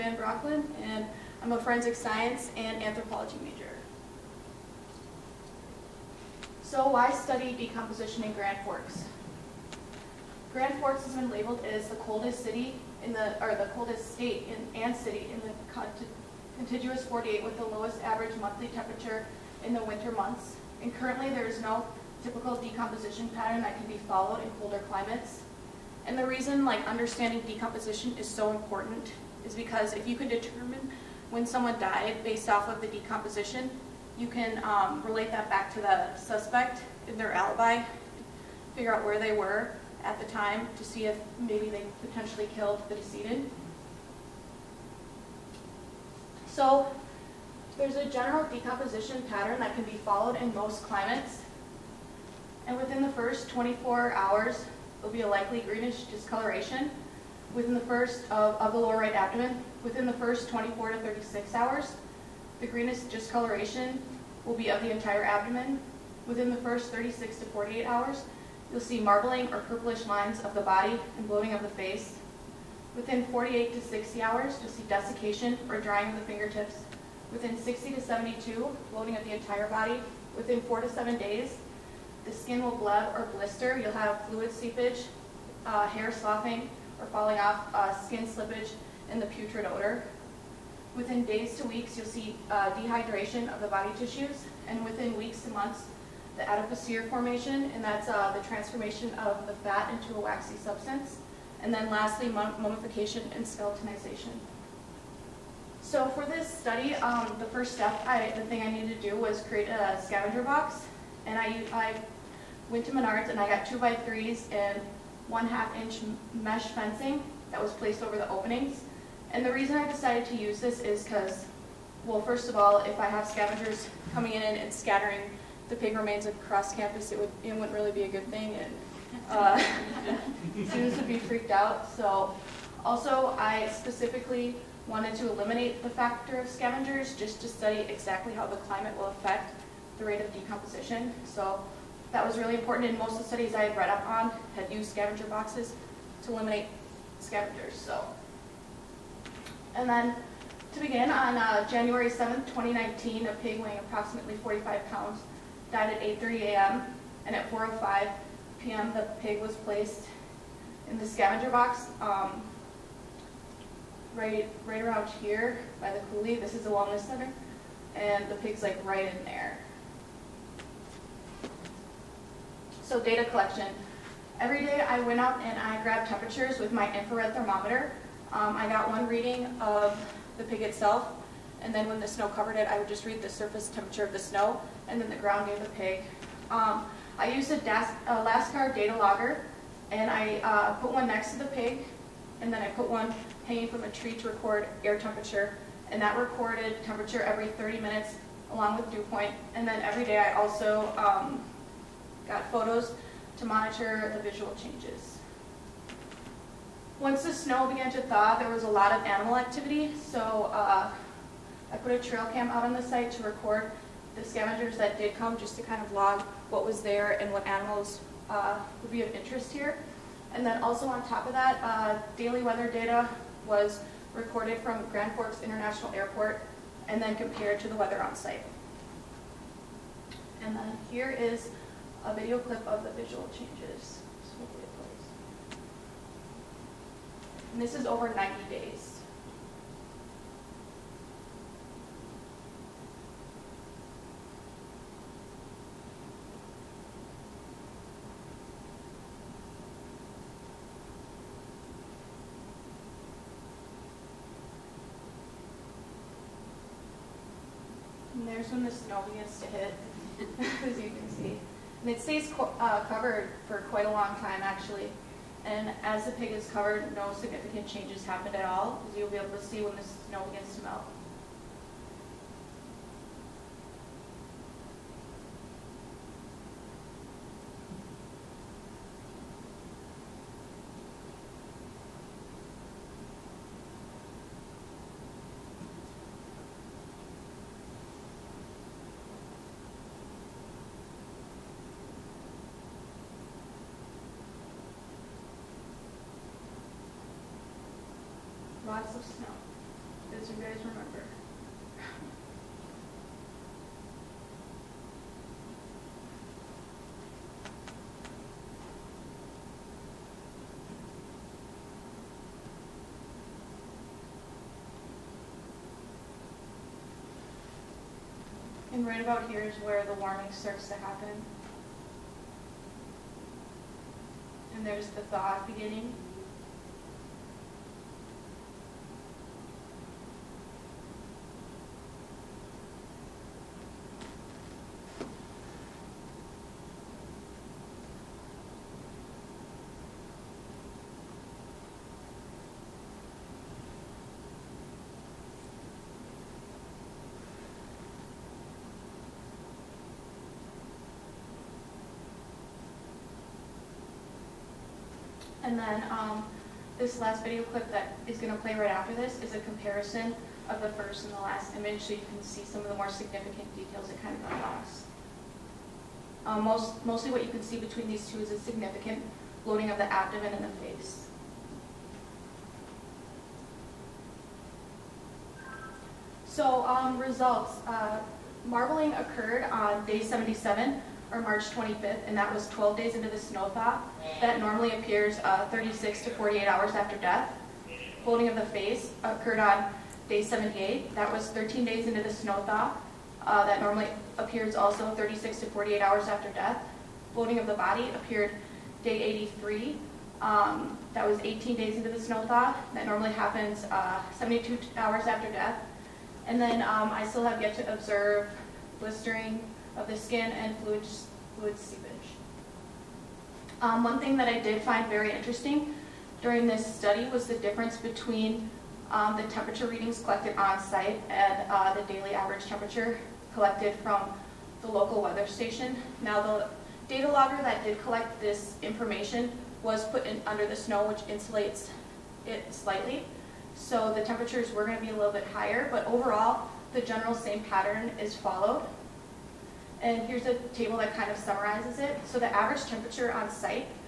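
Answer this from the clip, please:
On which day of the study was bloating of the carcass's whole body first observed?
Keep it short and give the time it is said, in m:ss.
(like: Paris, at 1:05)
Day 83, at 6:38.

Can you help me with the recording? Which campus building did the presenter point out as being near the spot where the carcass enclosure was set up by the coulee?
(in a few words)
the wellness center.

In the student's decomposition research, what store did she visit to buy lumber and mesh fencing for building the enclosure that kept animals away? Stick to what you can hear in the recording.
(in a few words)
Menards.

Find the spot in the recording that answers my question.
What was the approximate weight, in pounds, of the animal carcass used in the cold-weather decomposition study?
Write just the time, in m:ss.
2:34.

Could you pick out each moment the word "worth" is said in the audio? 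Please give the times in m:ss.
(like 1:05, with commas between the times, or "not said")
not said.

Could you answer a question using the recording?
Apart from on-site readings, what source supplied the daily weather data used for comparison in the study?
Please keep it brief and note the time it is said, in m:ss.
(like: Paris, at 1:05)
Grand Forks International Airport, at 3:44.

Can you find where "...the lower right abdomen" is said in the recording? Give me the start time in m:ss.
0:58.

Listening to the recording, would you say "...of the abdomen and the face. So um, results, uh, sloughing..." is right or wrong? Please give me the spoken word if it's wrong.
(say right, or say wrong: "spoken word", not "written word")
wrong: "marbling", not "sloughing".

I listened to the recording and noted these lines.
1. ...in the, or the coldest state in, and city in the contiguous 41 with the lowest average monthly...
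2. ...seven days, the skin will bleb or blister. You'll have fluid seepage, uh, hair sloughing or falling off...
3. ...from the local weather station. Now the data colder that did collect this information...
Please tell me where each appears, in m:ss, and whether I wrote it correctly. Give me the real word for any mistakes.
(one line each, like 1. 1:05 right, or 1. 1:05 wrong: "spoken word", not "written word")
1. 0:13 wrong: "48", not "41"
2. 1:20 right
3. 7:03 wrong: "logger", not "colder".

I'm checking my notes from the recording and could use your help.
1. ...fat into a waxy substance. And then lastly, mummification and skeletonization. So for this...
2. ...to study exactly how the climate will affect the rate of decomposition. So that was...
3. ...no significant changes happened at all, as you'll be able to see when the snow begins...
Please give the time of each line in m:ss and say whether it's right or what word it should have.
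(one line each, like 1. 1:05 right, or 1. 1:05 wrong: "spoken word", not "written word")
1. 1:39 right
2. 2:17 right
3. 4:26 right.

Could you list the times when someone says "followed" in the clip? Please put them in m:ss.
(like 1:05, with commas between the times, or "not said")
0:24, 0:50, 7:18.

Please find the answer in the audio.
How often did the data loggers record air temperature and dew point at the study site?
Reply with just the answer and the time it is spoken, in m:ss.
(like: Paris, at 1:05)
every 30 minutes, at 3:17.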